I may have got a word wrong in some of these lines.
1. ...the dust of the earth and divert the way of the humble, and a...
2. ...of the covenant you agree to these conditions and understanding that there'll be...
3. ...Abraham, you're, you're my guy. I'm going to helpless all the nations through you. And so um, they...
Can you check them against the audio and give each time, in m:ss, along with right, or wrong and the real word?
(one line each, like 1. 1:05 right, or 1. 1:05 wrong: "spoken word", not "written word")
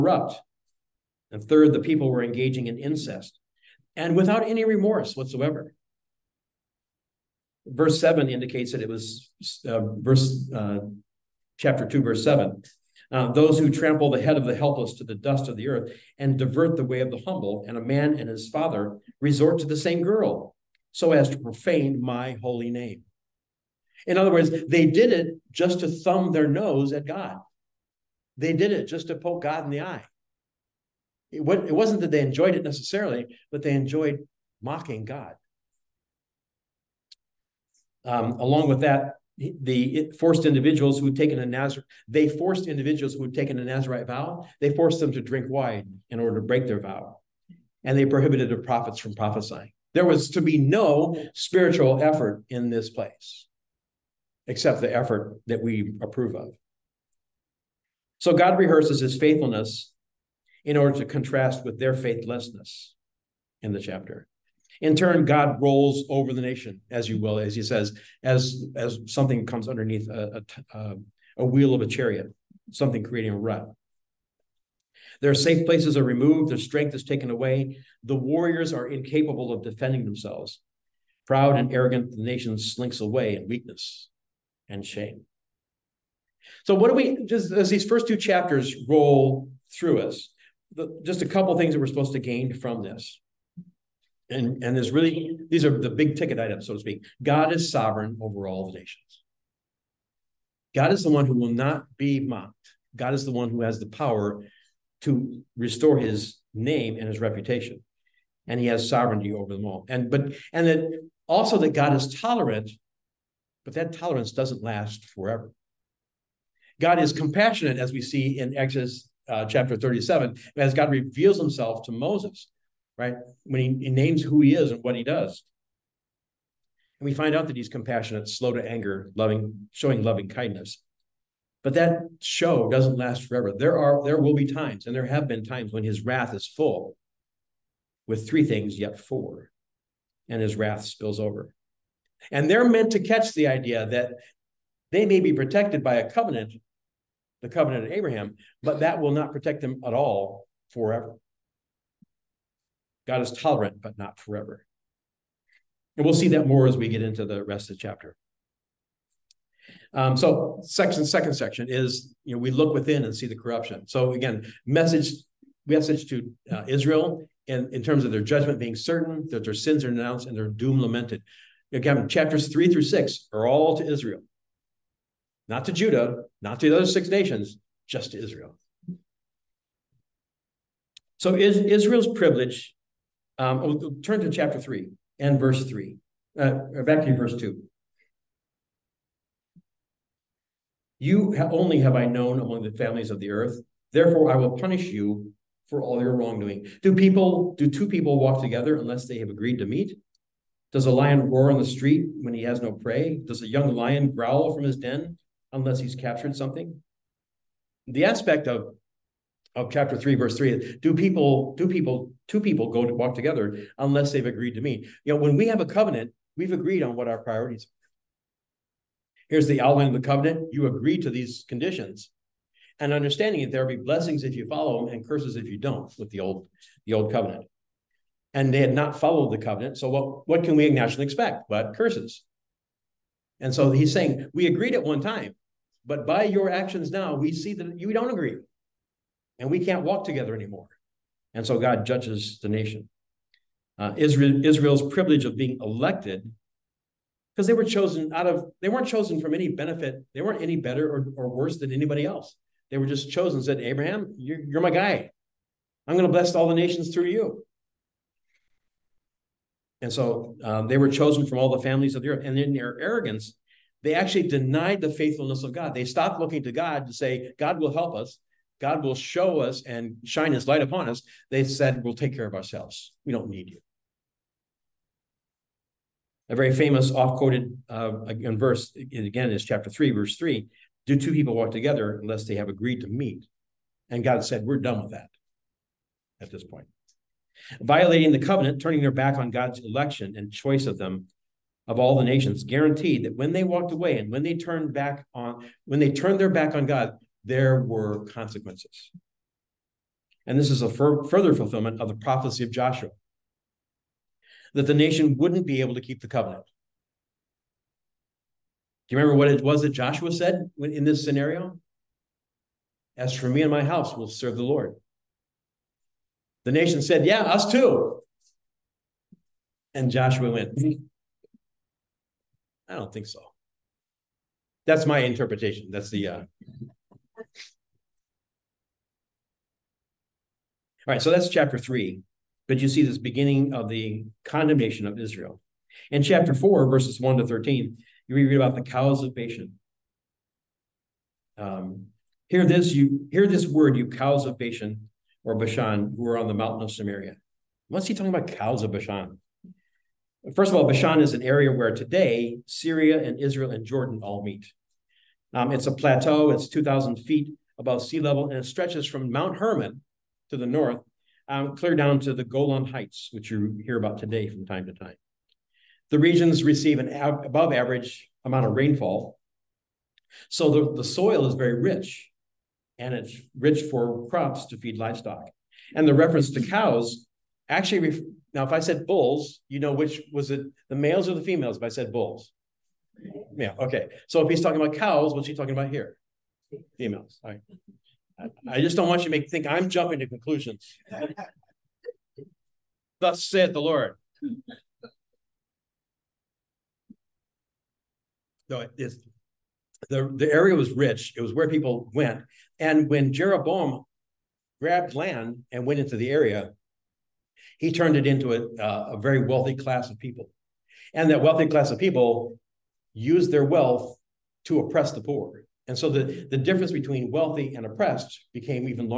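1. 0:15 right
2. 3:39 right
3. 4:13 wrong: "bless", not "helpless".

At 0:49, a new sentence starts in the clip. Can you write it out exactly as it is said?
There was to be no spiritual effort in this place, except the effort that we approve of.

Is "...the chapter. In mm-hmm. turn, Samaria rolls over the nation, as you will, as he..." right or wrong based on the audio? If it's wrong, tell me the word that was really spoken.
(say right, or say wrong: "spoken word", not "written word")
wrong: "God", not "Samaria".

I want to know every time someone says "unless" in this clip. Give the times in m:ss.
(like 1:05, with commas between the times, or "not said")
3:18, 3:25, 3:33, 4:42.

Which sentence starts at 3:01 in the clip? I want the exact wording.
So is, Israel's privilege um, we'll oh, turn to chapter 3 and verse 3, uh, back to verse 2.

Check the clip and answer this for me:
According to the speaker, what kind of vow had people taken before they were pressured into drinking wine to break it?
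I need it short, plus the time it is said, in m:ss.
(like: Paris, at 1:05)
Nazarite vow, at 0:43.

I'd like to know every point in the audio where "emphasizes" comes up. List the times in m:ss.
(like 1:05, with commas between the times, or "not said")
not said.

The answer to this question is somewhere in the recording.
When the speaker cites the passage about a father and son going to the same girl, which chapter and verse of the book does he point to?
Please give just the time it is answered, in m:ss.
0:11.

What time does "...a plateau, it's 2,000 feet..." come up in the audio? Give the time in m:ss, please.
5:55.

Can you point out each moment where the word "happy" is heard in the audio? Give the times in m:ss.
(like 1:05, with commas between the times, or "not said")
not said.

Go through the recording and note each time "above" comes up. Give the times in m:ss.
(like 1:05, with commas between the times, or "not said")
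5:57, 6:06.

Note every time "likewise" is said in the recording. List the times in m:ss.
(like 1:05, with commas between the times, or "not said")
not said.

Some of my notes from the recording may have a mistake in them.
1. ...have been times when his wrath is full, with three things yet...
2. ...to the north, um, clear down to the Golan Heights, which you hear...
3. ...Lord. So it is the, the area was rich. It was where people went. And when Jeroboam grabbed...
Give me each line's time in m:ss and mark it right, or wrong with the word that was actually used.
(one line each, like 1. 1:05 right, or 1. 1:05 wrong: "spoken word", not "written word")
1. 2:15 right
2. 6:00 right
3. 6:33 right.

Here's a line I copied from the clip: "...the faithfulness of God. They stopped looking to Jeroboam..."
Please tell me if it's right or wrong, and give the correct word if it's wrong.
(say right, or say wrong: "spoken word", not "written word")
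wrong: "God", not "Jeroboam".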